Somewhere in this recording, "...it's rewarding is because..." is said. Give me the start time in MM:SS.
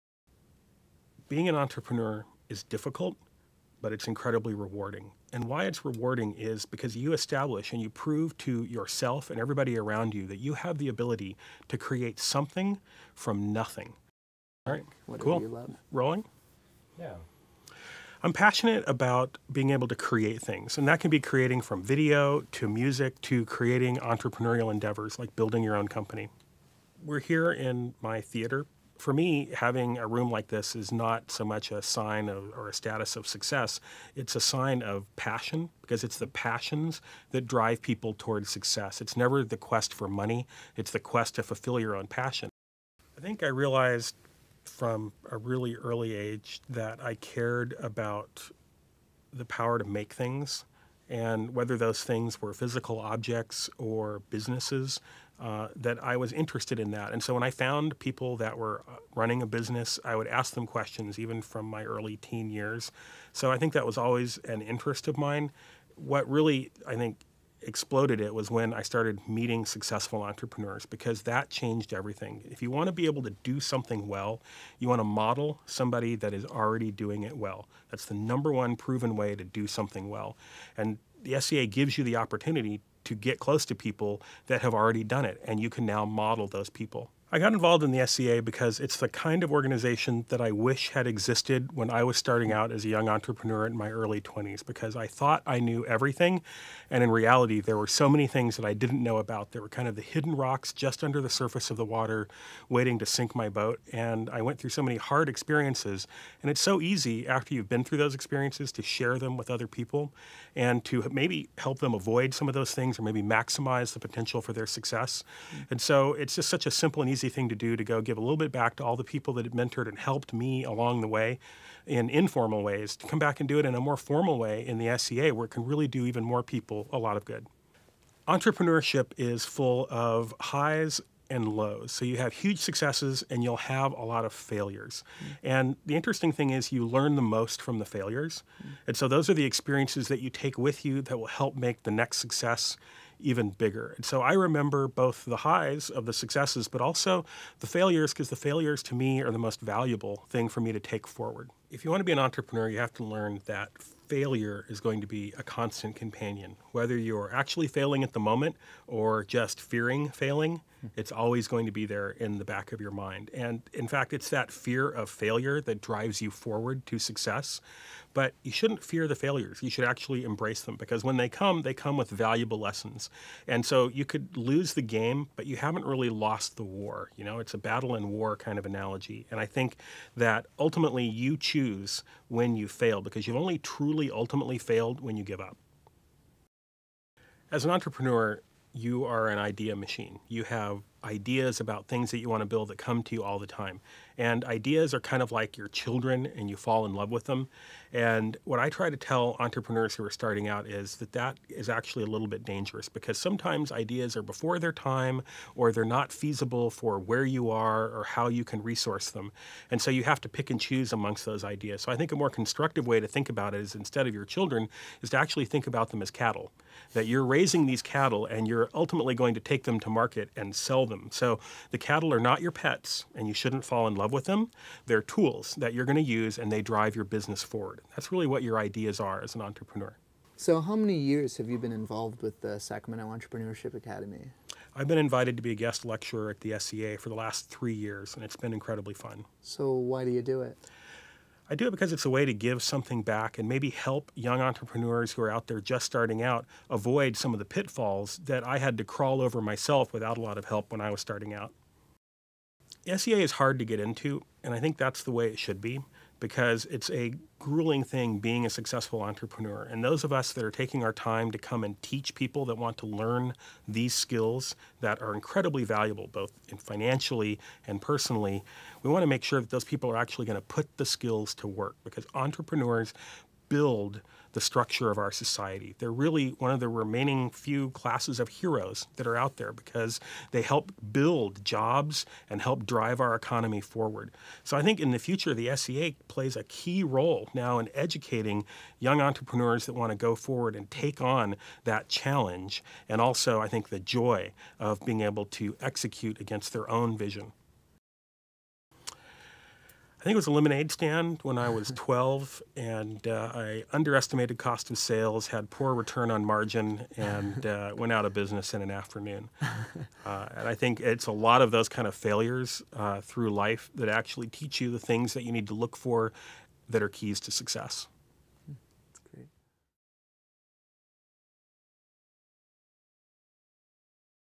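00:05.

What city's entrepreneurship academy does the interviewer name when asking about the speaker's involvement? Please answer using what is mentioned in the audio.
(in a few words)
Sacramento.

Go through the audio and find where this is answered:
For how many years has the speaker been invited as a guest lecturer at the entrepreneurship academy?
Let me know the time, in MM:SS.
03:57.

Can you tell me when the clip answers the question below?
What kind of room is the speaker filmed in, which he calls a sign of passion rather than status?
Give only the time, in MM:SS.
00:28.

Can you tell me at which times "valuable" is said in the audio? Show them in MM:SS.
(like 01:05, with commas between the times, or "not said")
02:29, 02:52, 04:25.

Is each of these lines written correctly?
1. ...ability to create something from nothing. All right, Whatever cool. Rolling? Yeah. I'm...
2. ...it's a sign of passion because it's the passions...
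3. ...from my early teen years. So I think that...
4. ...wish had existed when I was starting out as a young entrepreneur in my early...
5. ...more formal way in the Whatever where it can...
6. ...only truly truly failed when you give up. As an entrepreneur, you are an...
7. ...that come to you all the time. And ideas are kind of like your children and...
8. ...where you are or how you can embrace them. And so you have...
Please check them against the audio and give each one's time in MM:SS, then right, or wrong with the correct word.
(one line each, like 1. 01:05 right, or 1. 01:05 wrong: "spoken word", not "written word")
1. 00:10 right
2. 00:34 right
3. 01:01 right
4. 01:30 right
5. 02:03 wrong: "SEA", not "Whatever"
6. 03:03 wrong: "ultimately", not "truly"
7. 03:12 right
8. 03:26 wrong: "resource", not "embrace".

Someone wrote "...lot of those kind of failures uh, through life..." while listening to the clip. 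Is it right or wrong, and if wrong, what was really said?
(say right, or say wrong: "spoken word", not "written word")
right.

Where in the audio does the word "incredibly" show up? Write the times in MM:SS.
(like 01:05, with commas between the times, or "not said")
00:04, 03:58, 04:25.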